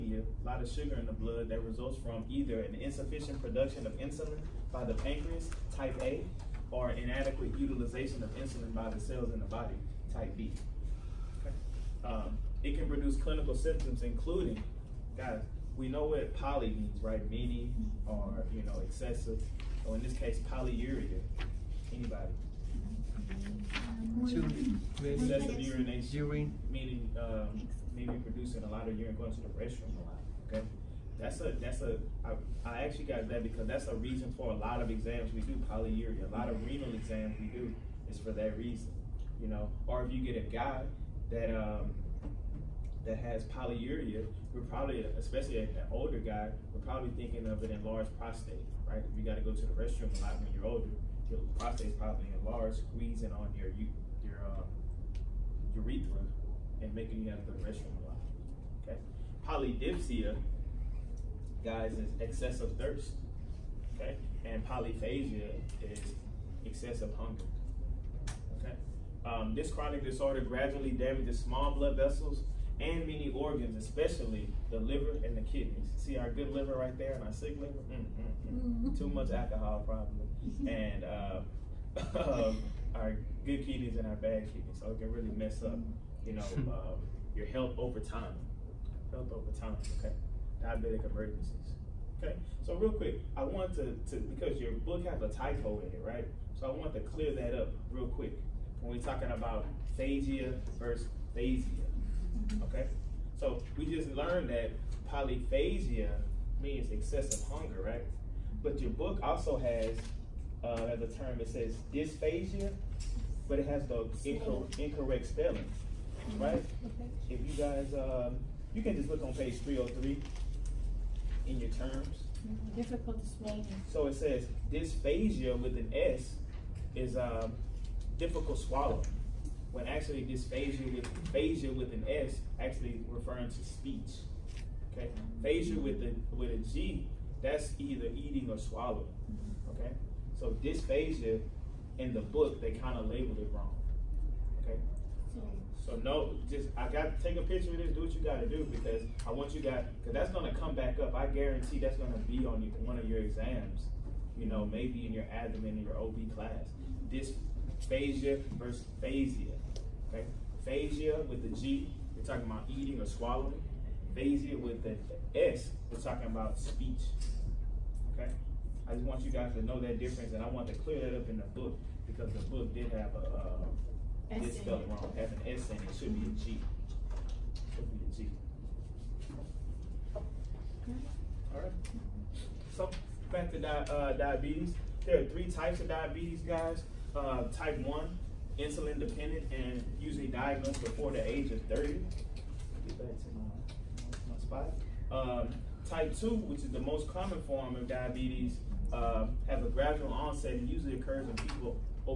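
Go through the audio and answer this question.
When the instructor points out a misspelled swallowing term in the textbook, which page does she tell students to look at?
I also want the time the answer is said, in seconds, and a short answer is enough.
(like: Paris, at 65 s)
303, at 119 s.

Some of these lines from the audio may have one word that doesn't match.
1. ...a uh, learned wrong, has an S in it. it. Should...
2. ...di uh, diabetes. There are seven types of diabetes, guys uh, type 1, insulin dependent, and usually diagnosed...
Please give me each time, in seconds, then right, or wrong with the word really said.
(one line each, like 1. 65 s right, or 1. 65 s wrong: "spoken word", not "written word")
1. 173 s wrong: "spelled", not "learned"
2. 183 s wrong: "three", not "seven".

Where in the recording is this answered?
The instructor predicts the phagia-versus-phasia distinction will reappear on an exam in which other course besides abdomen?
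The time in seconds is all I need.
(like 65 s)
155 s.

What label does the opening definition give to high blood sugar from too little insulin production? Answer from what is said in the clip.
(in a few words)
Type A.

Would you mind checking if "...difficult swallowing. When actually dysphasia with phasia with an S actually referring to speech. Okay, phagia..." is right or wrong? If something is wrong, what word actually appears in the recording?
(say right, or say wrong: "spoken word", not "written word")
right.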